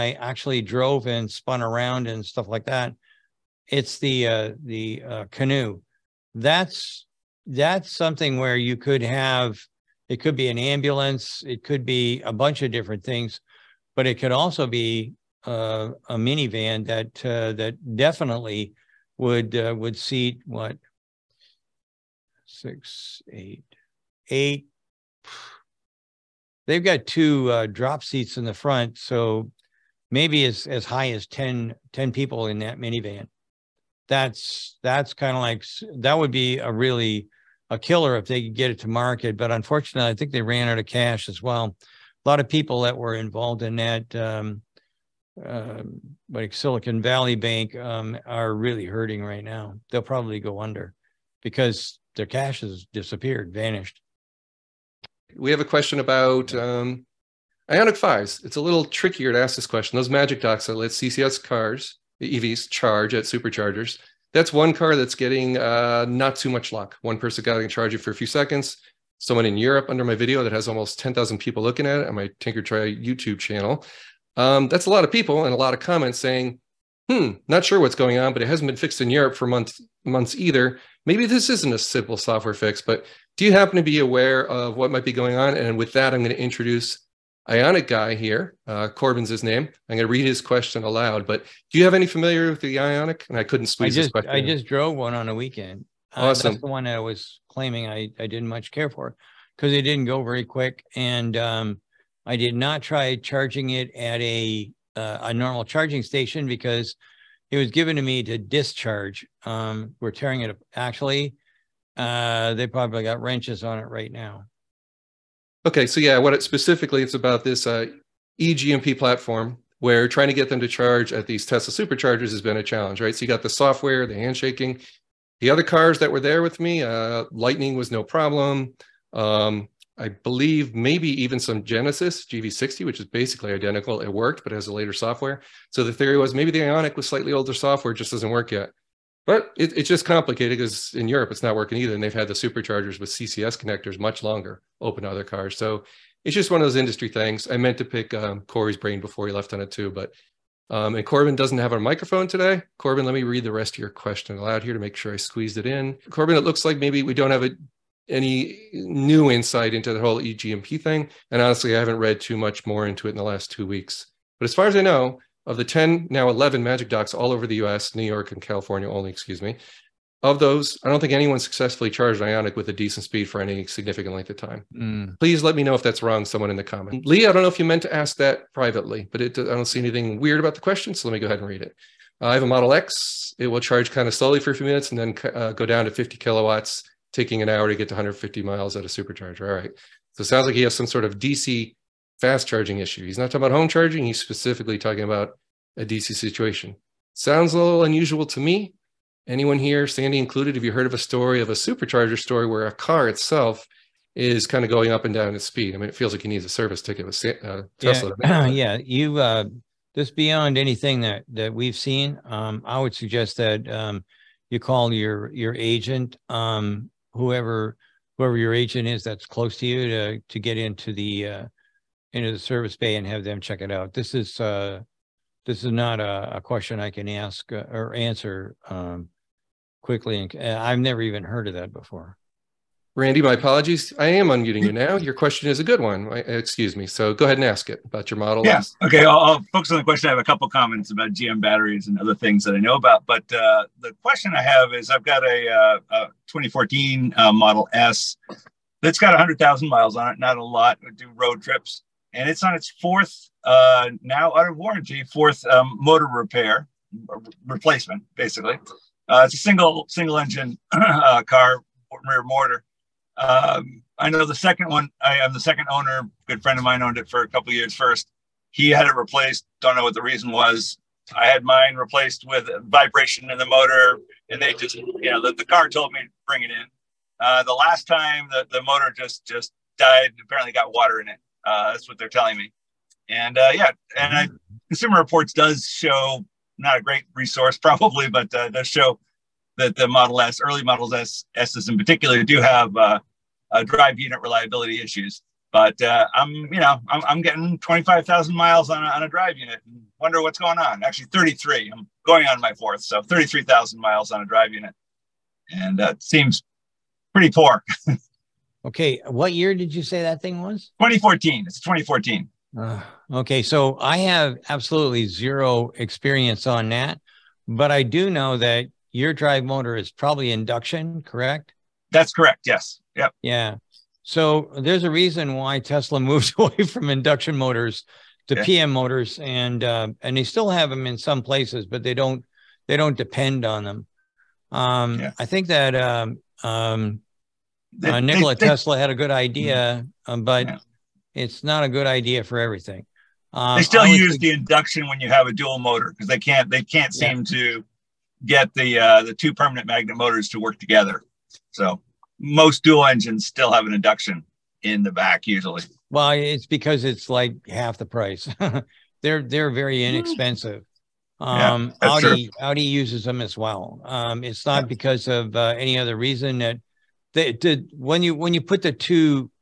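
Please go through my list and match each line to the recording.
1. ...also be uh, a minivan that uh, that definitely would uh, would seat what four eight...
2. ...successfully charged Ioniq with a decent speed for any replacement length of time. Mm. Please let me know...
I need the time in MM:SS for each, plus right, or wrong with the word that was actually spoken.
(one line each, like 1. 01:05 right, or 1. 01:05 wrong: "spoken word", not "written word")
1. 00:14 wrong: "six", not "four"
2. 02:51 wrong: "significant", not "replacement".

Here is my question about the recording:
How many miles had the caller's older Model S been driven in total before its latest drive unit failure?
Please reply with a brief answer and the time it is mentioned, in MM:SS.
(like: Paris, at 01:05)
100,000 miles, at 04:09.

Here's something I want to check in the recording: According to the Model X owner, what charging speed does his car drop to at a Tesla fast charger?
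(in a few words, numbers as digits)
50 kilowatts.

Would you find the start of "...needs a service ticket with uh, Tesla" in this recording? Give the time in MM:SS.
03:26.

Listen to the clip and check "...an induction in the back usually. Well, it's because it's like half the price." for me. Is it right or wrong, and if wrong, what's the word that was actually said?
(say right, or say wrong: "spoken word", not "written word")
right.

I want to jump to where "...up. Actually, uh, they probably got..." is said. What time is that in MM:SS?
01:50.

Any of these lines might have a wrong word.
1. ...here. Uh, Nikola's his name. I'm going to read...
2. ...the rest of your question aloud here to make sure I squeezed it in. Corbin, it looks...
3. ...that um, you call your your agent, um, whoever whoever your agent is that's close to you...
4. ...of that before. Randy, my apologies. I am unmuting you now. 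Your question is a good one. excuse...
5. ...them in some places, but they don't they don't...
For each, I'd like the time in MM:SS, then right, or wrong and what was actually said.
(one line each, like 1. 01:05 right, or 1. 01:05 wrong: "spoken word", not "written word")
1. 01:28 wrong: "Corbin", not "Nikola"
2. 02:33 right
3. 03:33 right
4. 03:51 right
5. 05:30 right.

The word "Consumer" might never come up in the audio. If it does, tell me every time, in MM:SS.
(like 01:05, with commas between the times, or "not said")
04:44.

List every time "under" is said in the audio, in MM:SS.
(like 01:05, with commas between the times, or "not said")
00:50, 01:09.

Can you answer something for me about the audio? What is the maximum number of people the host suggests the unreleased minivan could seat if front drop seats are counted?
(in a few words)
10.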